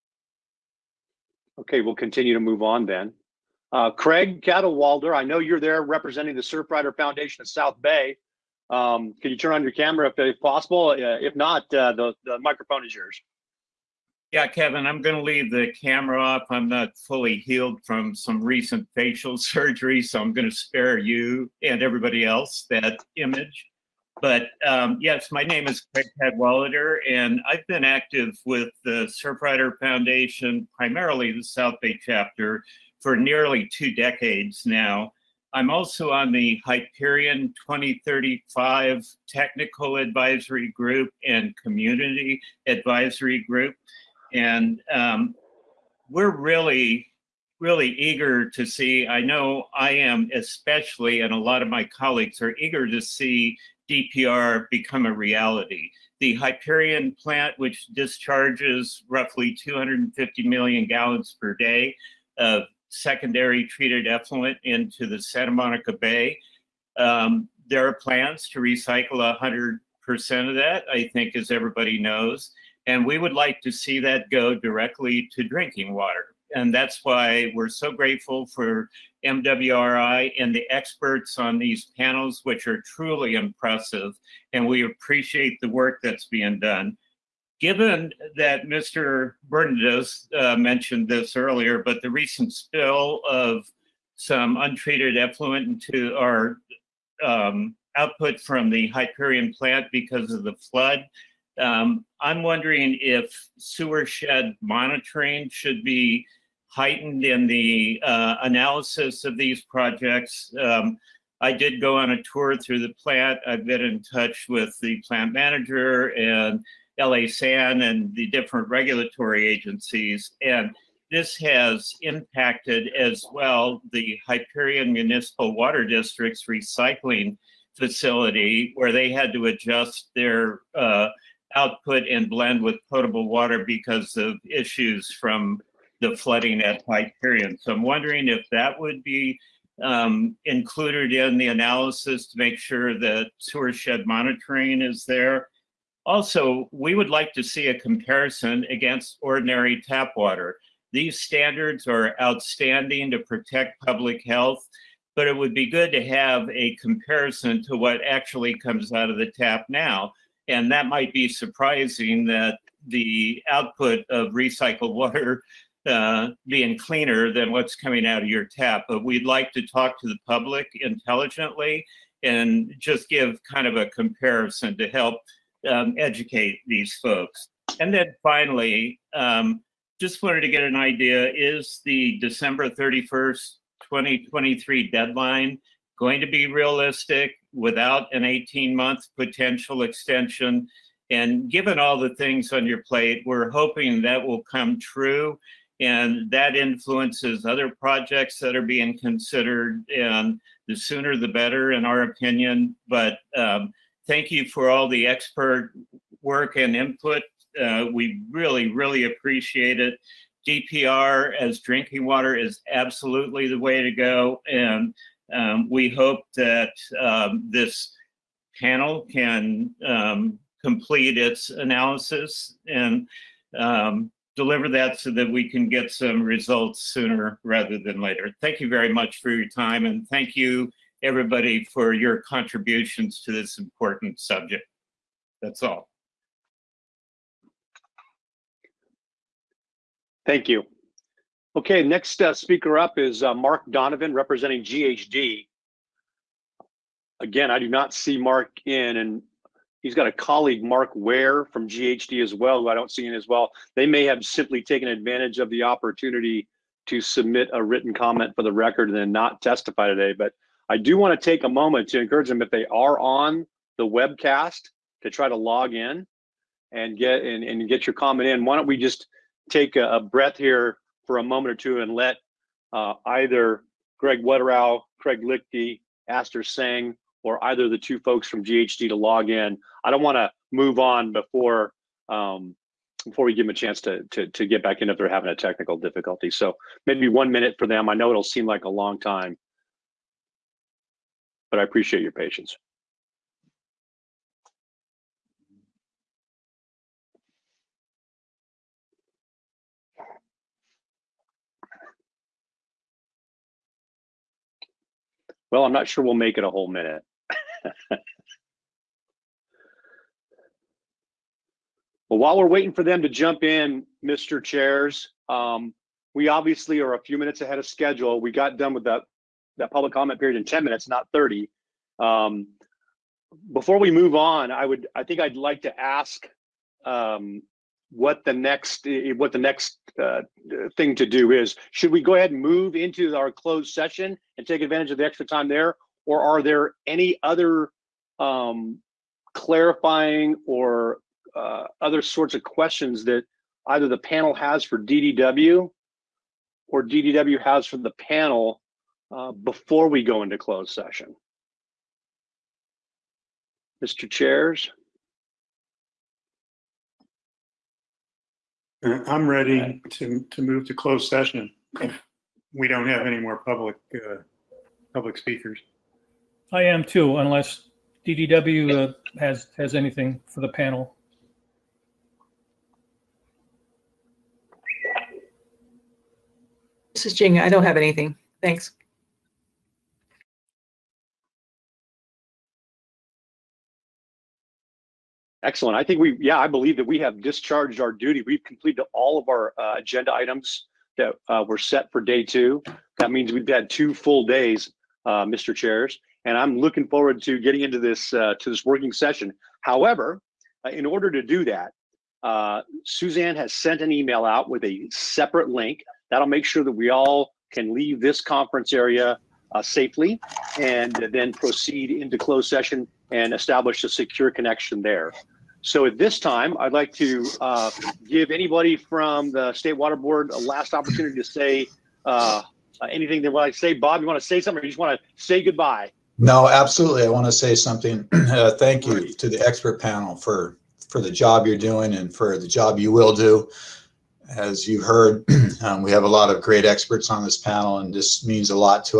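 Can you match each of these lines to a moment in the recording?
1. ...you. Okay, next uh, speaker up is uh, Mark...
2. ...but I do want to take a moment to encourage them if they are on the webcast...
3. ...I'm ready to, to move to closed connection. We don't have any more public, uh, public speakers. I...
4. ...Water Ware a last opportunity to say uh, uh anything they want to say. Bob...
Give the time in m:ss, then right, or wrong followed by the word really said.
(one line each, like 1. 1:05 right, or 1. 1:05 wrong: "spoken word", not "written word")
1. 4:00 right
2. 4:20 right
3. 5:59 wrong: "session", not "connection"
4. 6:59 wrong: "Board", not "Ware".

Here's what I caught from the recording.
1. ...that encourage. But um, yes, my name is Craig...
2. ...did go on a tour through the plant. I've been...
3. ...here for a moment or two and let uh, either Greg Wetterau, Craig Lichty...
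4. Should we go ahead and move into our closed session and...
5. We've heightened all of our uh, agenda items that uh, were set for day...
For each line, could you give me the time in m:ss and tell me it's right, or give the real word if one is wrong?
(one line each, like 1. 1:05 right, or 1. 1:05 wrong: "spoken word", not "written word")
1. 0:22 wrong: "image", not "encourage"
2. 1:51 right
3. 4:30 right
4. 5:31 right
5. 6:28 wrong: "completed", not "heightened".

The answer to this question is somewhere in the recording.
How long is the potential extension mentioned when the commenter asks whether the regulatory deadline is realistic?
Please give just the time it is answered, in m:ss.
3:08.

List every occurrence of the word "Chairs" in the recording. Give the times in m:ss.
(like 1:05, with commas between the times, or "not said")
5:14, 5:54, 6:35.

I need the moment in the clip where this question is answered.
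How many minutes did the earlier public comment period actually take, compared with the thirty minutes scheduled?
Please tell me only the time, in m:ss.
5:20.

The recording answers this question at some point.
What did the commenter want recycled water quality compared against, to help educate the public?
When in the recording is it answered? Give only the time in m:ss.
2:29.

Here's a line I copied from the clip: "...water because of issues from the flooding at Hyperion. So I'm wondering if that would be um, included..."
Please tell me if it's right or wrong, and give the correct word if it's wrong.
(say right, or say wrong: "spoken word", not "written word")
right.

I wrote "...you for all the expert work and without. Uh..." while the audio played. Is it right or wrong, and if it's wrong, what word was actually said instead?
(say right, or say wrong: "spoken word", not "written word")
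wrong: "input", not "without".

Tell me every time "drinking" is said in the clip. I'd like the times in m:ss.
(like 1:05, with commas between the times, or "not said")
1:15, 3:31.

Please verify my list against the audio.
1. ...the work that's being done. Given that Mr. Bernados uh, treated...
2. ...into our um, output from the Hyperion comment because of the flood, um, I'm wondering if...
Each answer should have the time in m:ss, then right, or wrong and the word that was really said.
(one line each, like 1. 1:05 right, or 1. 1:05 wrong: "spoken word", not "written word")
1. 1:25 wrong: "mentioned", not "treated"
2. 1:35 wrong: "plant", not "comment".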